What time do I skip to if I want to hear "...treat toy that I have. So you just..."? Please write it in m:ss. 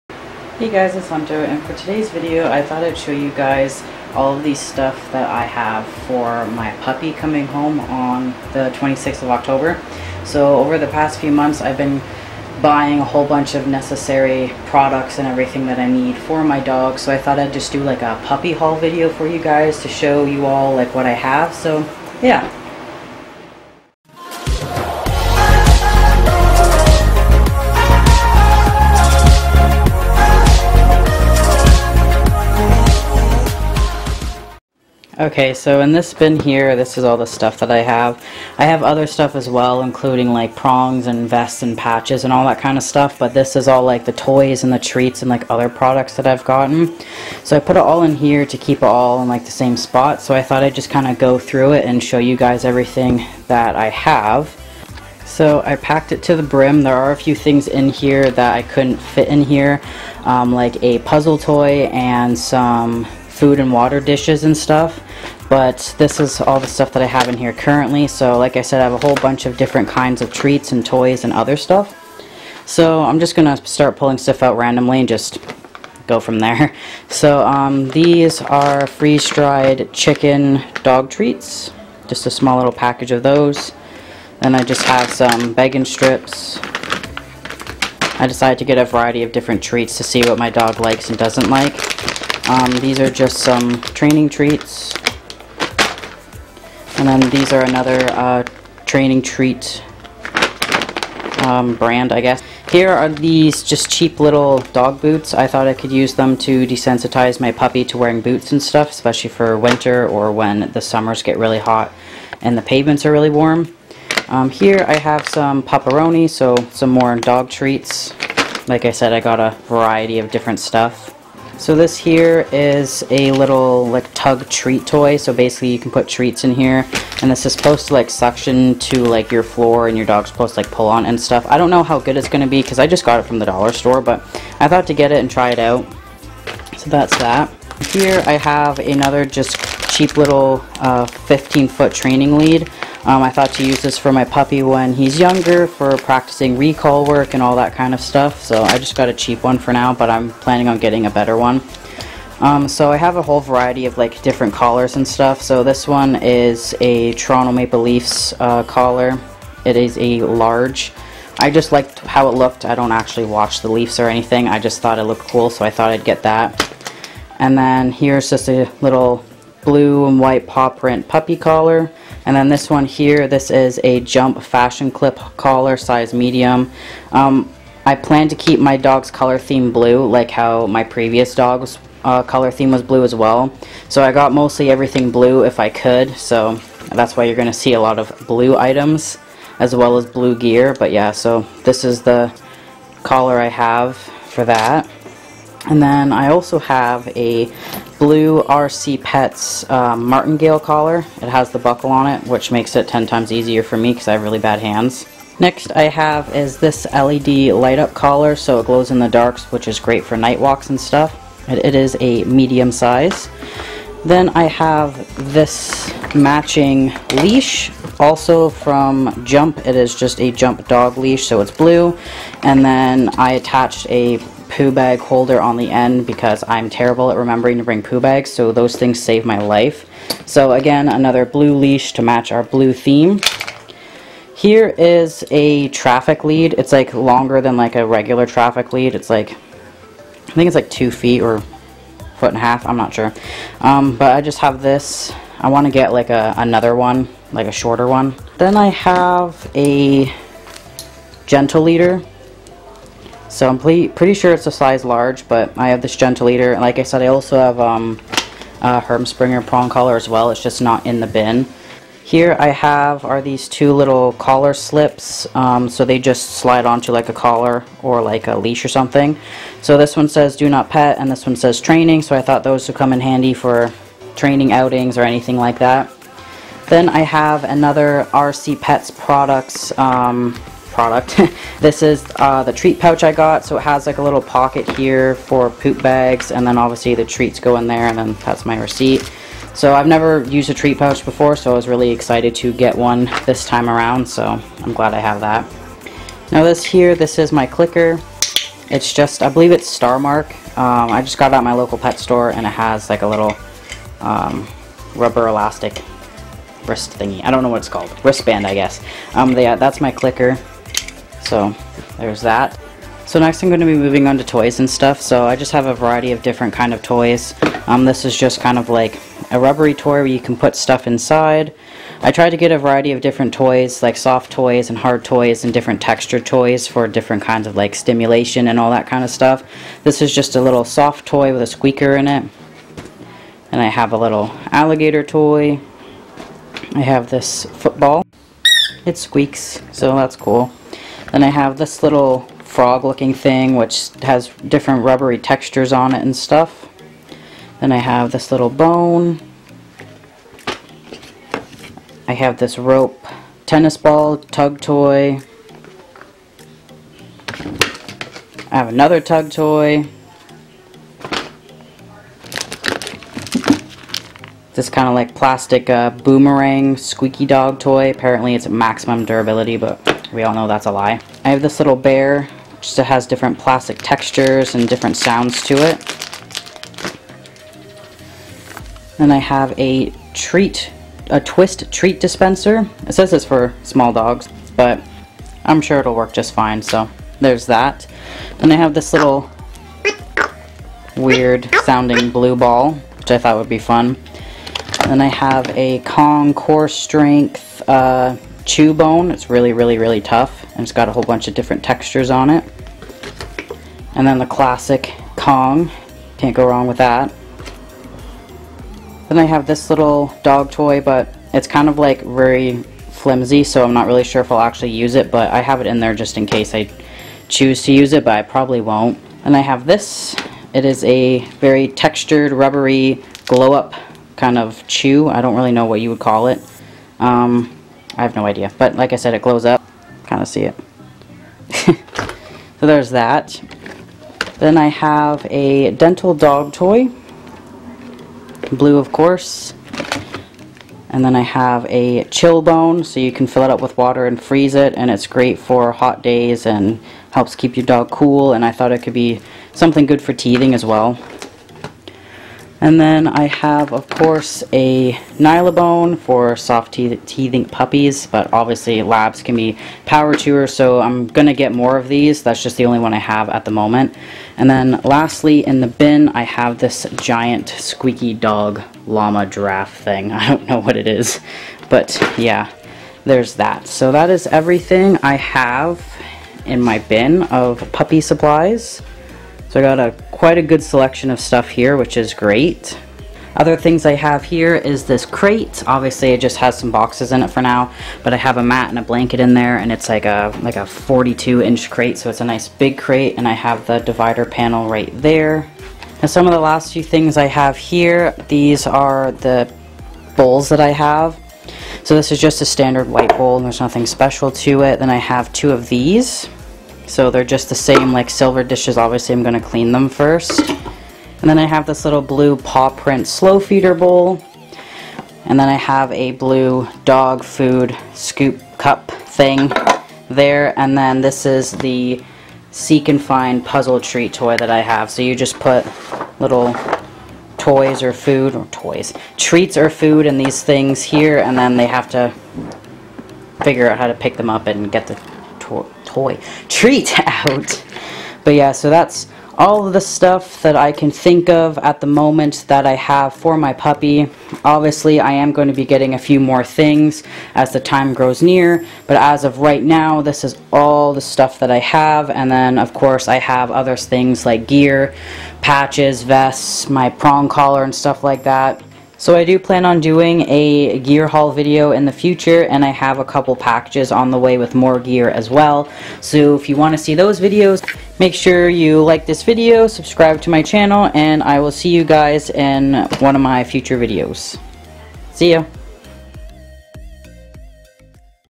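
8:43.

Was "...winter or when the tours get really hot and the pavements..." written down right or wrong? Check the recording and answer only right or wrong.
wrong.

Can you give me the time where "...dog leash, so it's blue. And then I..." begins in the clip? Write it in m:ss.
3:40.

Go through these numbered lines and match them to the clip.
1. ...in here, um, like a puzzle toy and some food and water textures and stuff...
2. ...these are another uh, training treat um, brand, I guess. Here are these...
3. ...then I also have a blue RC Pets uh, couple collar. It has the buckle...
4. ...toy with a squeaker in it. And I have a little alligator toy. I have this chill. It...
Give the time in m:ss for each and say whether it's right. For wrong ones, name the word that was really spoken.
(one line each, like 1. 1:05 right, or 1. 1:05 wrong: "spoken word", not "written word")
1. 0:59 wrong: "dishes", not "textures"
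2. 1:37 right
3. 3:15 wrong: "martingale", not "couple"
4. 5:31 wrong: "football", not "chill".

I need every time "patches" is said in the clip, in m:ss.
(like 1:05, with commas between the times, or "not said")
0:41, 9:15.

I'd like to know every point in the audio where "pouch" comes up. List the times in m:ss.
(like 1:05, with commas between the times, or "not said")
4:42, 4:50.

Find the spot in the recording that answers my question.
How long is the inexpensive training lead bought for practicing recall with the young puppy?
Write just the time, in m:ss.
2:21.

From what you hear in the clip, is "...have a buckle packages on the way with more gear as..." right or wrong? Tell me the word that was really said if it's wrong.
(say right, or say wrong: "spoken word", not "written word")
wrong: "couple", not "buckle".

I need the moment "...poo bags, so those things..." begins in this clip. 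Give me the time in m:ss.
3:47.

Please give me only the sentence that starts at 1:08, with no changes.
So like I said, I have a whole bunch of different kinds of treats and toys and other stuff.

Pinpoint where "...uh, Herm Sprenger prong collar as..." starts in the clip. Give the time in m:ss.
4:18.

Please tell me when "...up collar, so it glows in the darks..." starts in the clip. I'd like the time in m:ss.
3:27.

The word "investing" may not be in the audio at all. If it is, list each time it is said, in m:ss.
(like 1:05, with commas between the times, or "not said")
not said.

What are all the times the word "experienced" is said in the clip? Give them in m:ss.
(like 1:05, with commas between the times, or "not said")
not said.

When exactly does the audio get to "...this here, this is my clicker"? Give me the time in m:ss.
4:56.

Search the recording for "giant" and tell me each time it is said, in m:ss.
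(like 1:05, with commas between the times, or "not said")
7:46.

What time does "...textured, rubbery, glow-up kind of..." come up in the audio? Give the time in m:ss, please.
7:01.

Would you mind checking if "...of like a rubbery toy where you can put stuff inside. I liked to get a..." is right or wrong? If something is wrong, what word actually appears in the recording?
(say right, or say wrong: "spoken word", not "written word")
wrong: "tried", not "liked".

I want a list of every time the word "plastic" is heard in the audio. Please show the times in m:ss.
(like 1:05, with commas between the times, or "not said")
6:05, 6:13.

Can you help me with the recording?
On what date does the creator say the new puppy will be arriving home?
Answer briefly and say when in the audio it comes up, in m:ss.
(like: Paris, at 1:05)
26th of October, at 0:08.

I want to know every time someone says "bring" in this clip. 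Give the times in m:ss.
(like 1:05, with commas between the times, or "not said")
3:47.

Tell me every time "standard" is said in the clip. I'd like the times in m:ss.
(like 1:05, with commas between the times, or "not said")
8:22.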